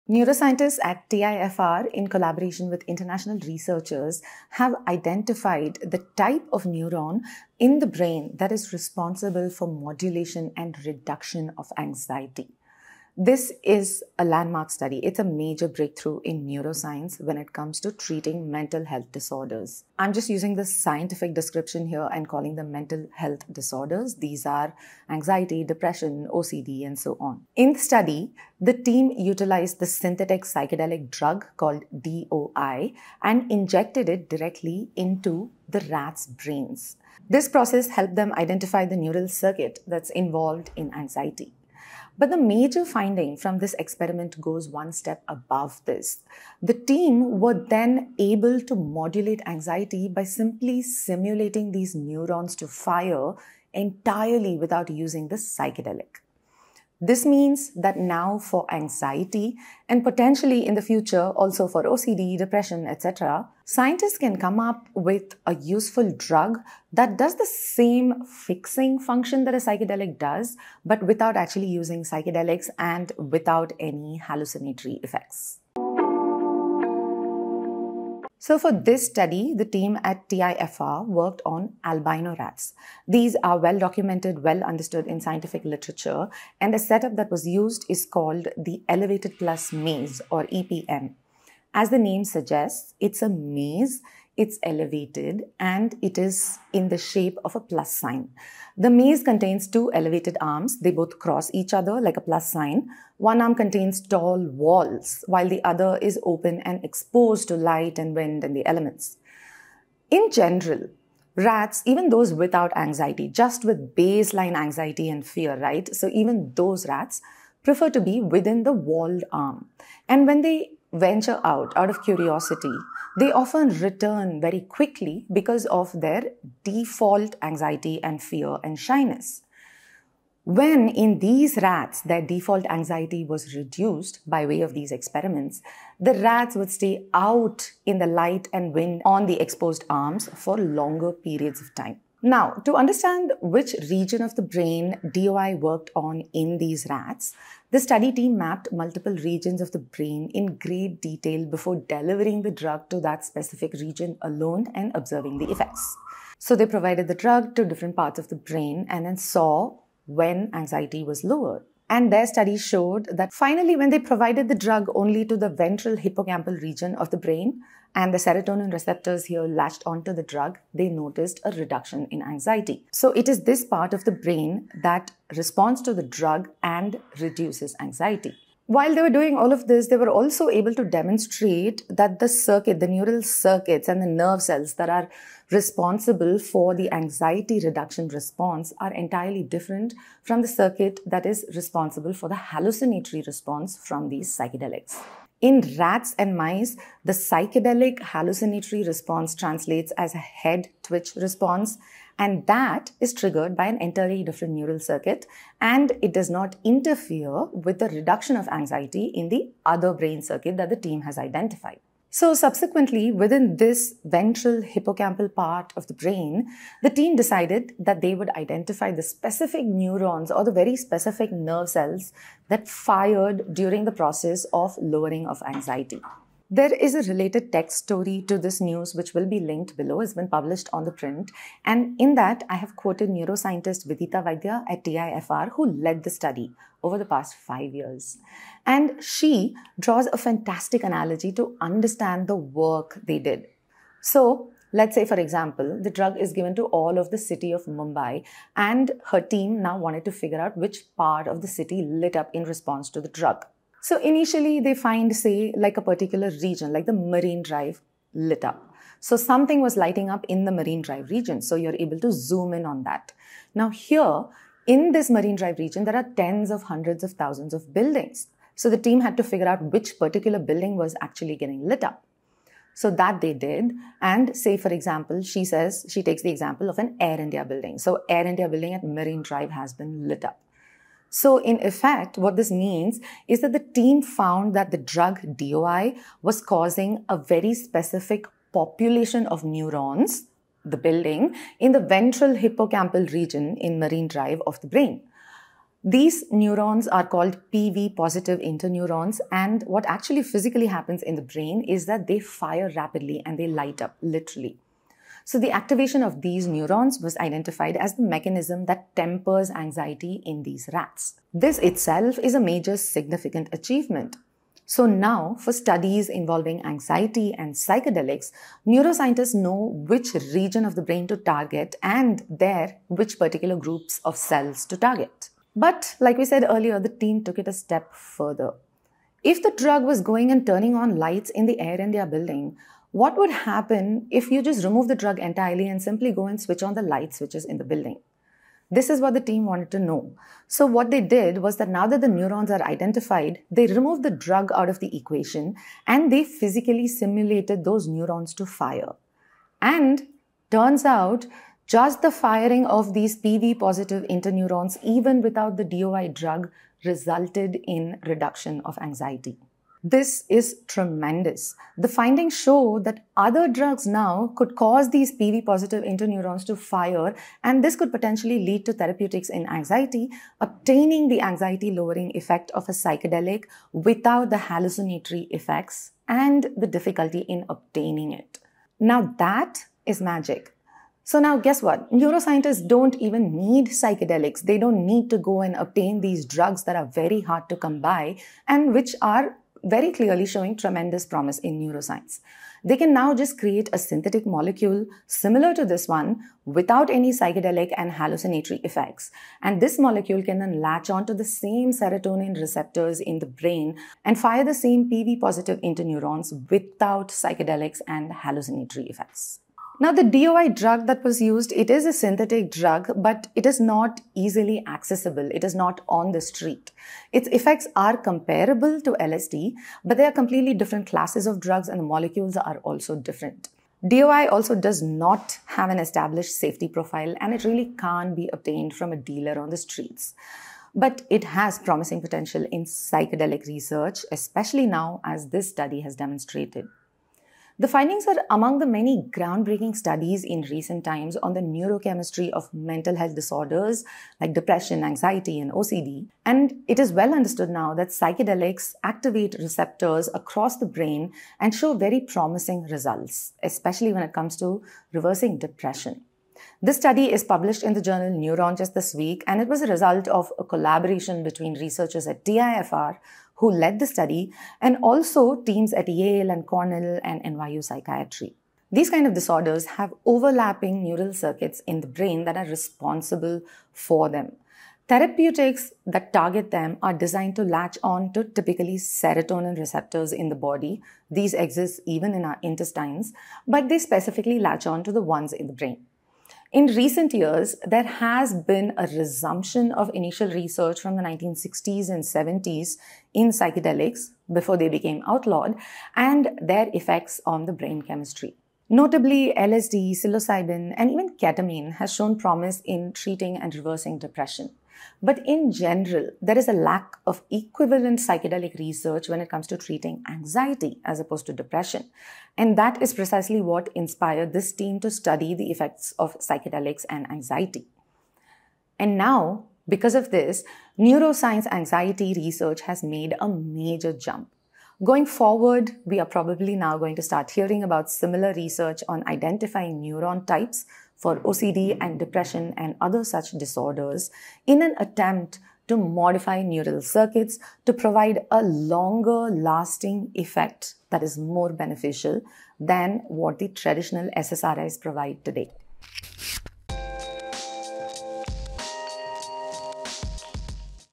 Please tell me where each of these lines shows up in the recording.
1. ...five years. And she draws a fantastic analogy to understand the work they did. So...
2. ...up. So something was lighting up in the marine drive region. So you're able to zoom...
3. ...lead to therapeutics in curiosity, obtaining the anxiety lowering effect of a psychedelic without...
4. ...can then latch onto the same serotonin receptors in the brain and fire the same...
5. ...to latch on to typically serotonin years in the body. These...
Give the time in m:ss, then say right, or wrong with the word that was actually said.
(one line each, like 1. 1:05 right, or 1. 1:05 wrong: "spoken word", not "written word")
1. 3:57 right
2. 4:18 right
3. 6:08 wrong: "anxiety", not "curiosity"
4. 6:40 right
5. 7:57 wrong: "receptors", not "years".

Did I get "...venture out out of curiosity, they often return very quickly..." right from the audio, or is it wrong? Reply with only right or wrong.
right.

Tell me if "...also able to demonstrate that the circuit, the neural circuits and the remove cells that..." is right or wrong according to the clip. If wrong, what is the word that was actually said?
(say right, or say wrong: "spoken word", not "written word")
wrong: "nerve", not "remove".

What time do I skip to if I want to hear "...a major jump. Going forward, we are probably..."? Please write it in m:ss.
8:43.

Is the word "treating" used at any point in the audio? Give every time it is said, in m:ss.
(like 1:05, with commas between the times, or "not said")
0:17, 8:22, 8:29.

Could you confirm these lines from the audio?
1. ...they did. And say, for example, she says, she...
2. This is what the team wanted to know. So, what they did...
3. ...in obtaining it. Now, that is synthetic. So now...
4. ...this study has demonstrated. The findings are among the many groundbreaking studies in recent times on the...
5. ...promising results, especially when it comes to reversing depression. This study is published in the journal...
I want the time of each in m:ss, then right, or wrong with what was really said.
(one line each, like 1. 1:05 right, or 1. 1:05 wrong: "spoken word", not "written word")
1. 4:33 right
2. 5:38 right
3. 6:17 wrong: "magic", not "synthetic"
4. 7:15 right
5. 7:32 right.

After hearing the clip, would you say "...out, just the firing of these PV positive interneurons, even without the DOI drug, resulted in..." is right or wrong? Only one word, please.
right.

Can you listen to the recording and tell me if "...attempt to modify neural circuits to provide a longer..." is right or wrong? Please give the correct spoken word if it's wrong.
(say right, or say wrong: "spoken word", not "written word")
right.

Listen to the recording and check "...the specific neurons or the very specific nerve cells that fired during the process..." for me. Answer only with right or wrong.
right.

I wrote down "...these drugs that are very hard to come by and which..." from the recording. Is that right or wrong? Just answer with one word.
right.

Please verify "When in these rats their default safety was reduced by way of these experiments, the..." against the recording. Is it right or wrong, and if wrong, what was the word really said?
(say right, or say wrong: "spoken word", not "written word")
wrong: "anxiety", not "safety".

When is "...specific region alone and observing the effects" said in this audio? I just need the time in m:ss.
2:33.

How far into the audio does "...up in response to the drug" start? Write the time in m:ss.
4:12.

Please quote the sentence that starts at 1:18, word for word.
So for this study, the team at TIFR worked on albino rats.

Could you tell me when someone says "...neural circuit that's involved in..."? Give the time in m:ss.
0:38.